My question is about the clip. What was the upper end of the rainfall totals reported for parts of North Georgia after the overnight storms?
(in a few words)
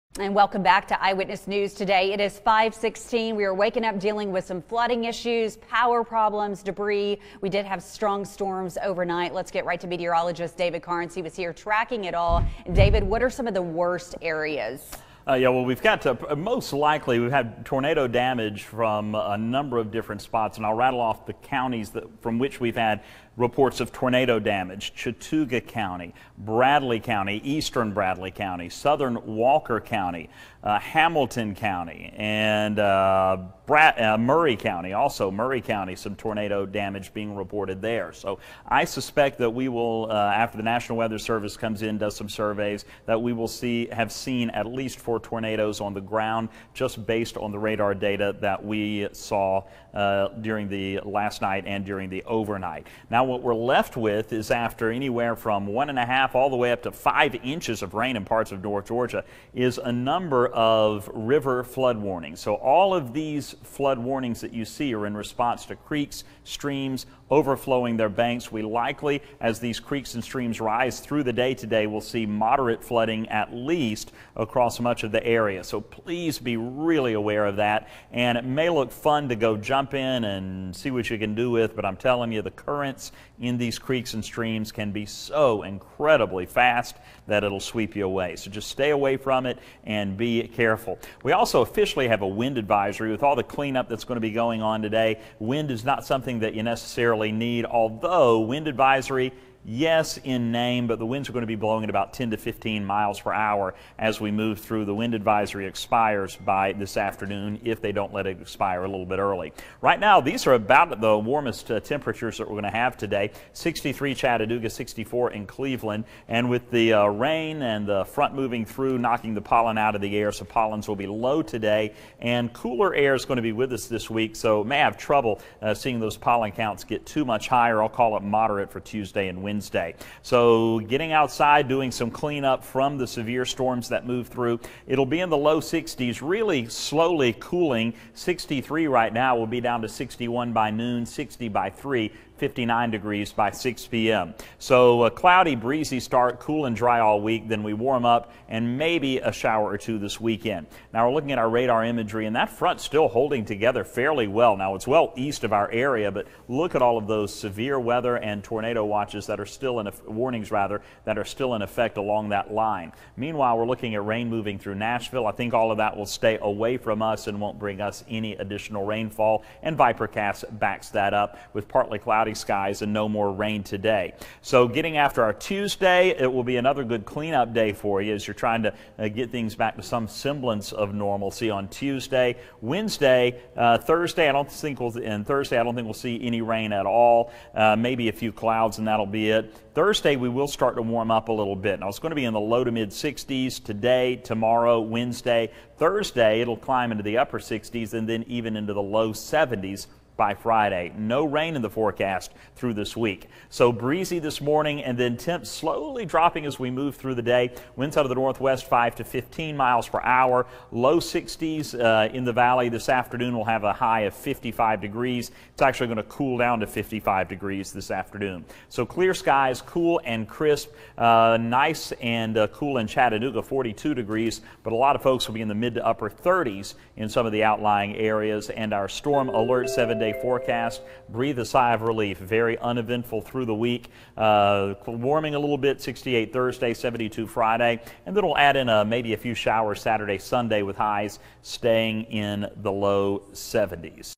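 5 inches.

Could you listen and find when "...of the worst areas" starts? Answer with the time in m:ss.
0:13.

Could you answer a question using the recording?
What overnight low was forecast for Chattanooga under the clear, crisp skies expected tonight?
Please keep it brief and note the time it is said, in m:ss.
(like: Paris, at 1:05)
42 degrees, at 3:43.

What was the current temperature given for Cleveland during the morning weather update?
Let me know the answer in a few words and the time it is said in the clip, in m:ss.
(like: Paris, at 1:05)
64, at 1:54.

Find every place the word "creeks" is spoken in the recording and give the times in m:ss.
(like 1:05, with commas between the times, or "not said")
1:05, 1:09, 1:23.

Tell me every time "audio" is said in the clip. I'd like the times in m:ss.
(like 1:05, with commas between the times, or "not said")
not said.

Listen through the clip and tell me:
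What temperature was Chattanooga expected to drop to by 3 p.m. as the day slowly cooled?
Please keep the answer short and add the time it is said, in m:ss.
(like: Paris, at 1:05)
60, at 2:21.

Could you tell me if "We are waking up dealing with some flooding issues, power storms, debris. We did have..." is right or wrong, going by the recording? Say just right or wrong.
wrong.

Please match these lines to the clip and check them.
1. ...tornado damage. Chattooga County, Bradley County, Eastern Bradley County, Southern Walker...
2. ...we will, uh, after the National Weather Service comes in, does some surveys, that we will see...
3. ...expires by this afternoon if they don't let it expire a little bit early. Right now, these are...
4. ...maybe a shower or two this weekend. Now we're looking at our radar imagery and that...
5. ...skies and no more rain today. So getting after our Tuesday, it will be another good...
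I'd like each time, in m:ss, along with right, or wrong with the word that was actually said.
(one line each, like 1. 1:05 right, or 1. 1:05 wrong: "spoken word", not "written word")
1. 0:23 right
2. 0:39 right
3. 1:45 right
4. 2:28 right
5. 2:52 right.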